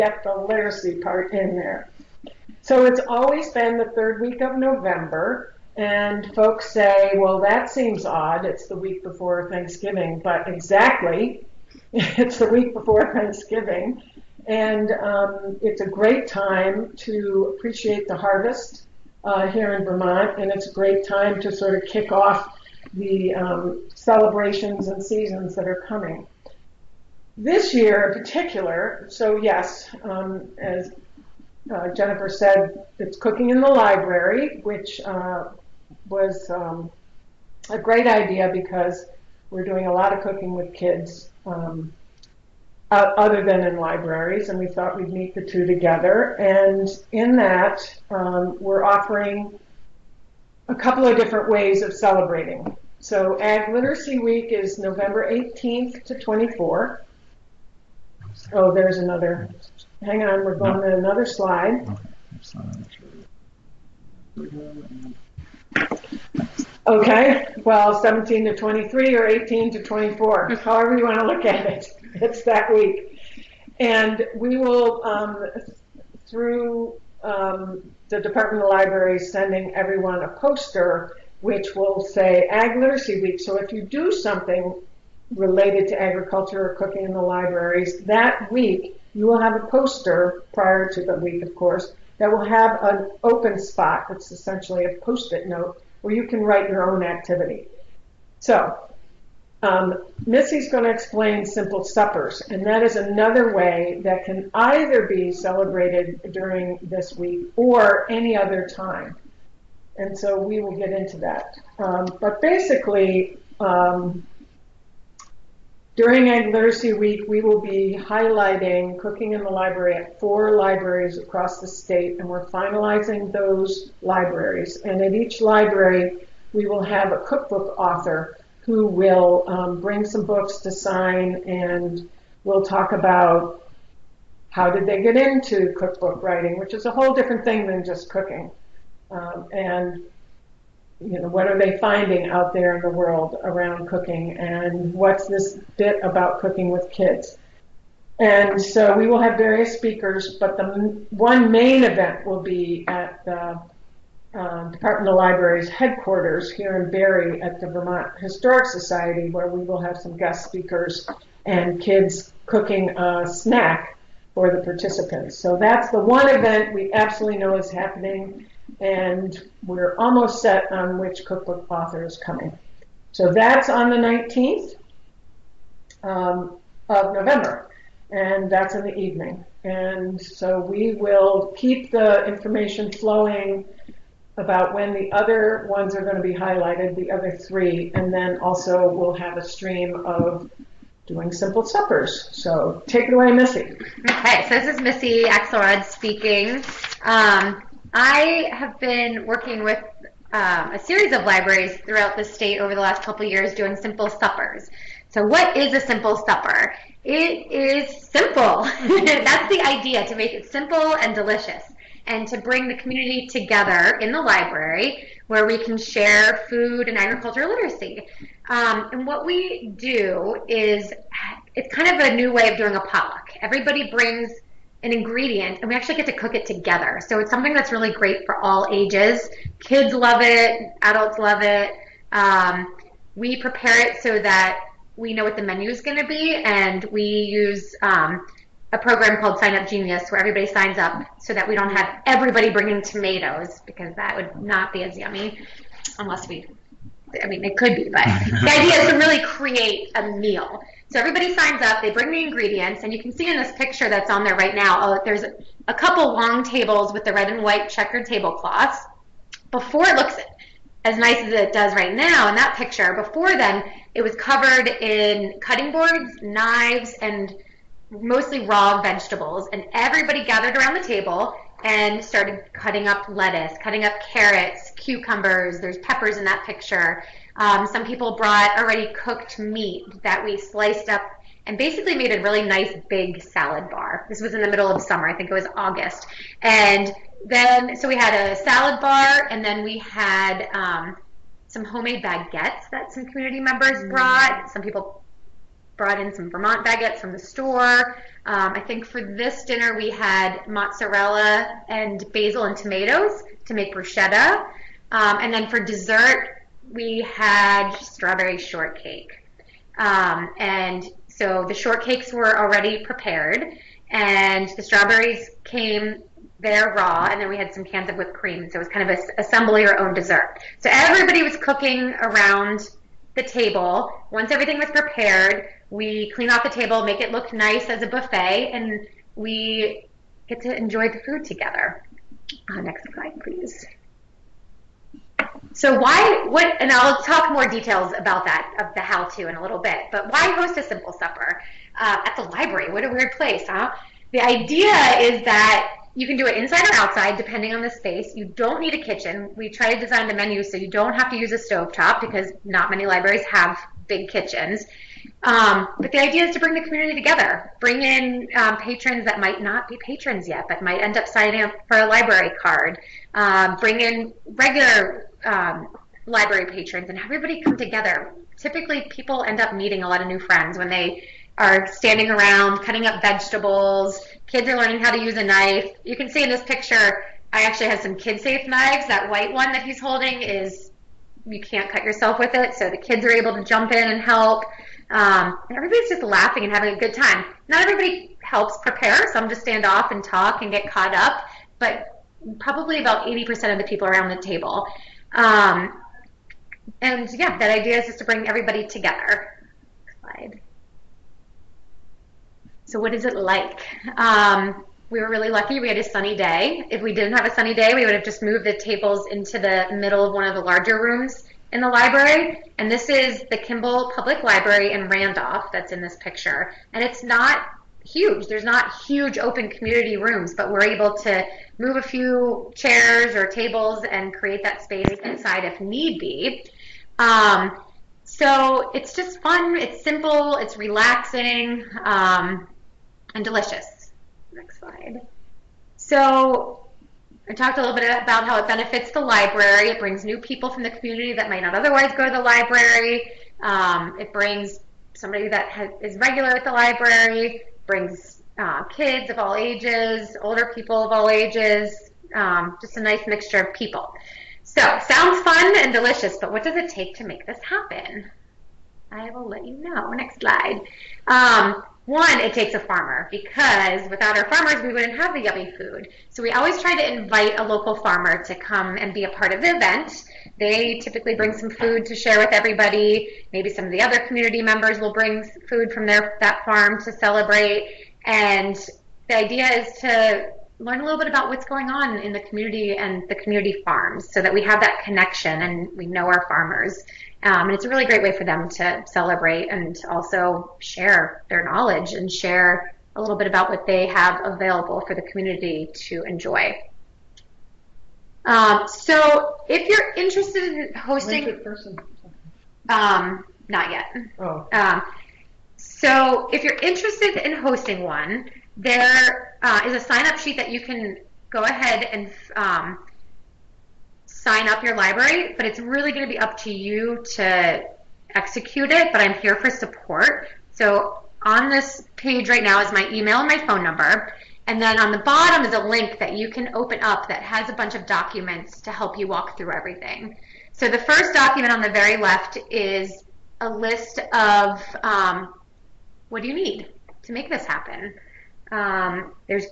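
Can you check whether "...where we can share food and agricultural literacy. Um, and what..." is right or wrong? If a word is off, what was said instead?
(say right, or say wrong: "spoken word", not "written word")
right.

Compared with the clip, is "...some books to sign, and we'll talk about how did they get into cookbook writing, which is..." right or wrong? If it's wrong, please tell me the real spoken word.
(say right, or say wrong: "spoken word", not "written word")
right.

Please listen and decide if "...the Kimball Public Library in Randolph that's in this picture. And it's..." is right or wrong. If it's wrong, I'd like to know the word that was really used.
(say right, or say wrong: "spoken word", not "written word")
right.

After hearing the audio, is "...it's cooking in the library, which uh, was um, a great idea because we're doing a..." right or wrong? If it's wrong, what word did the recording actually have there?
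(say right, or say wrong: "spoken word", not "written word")
right.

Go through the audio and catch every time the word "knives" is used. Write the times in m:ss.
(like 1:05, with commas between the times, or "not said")
4:26, 6:18.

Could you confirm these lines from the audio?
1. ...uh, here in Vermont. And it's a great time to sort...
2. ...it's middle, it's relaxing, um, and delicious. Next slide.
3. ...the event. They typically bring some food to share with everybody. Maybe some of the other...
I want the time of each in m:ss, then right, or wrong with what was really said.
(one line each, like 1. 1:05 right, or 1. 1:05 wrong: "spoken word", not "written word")
1. 0:19 right
2. 7:09 wrong: "simple", not "middle"
3. 7:49 right.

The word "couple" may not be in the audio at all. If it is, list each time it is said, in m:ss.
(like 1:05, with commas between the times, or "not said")
0:50, 3:23, 4:15.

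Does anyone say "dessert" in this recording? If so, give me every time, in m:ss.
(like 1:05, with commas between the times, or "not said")
5:05, 5:19.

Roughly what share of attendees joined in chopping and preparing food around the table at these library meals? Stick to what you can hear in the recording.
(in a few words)
80%.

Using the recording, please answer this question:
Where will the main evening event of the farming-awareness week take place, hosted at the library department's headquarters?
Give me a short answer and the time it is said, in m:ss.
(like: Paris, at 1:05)
Vermont Historic Society, at 2:37.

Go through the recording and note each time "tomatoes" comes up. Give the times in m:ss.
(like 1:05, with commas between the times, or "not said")
4:02, 5:02.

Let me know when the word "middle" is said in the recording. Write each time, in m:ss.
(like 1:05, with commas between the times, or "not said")
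4:44, 6:49.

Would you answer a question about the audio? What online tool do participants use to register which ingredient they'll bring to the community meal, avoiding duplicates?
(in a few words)
Sign Up Genius.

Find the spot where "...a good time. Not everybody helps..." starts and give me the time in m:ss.
6:26.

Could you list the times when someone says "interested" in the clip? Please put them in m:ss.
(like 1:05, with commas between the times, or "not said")
8:19, 8:26.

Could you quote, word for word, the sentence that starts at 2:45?
So that's the one event we absolutely know is happening and we're almost set on which cookbook author is coming.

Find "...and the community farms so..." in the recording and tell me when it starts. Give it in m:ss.
8:02.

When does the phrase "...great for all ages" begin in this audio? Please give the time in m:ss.
3:47.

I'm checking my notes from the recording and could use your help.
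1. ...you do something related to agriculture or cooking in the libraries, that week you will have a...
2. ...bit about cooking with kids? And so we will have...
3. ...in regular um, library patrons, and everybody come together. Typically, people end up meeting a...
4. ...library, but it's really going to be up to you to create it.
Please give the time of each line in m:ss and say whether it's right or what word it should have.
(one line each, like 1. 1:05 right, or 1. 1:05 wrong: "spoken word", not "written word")
1. 1:23 right
2. 2:25 right
3. 6:03 right
4. 8:34 wrong: "execute", not "create".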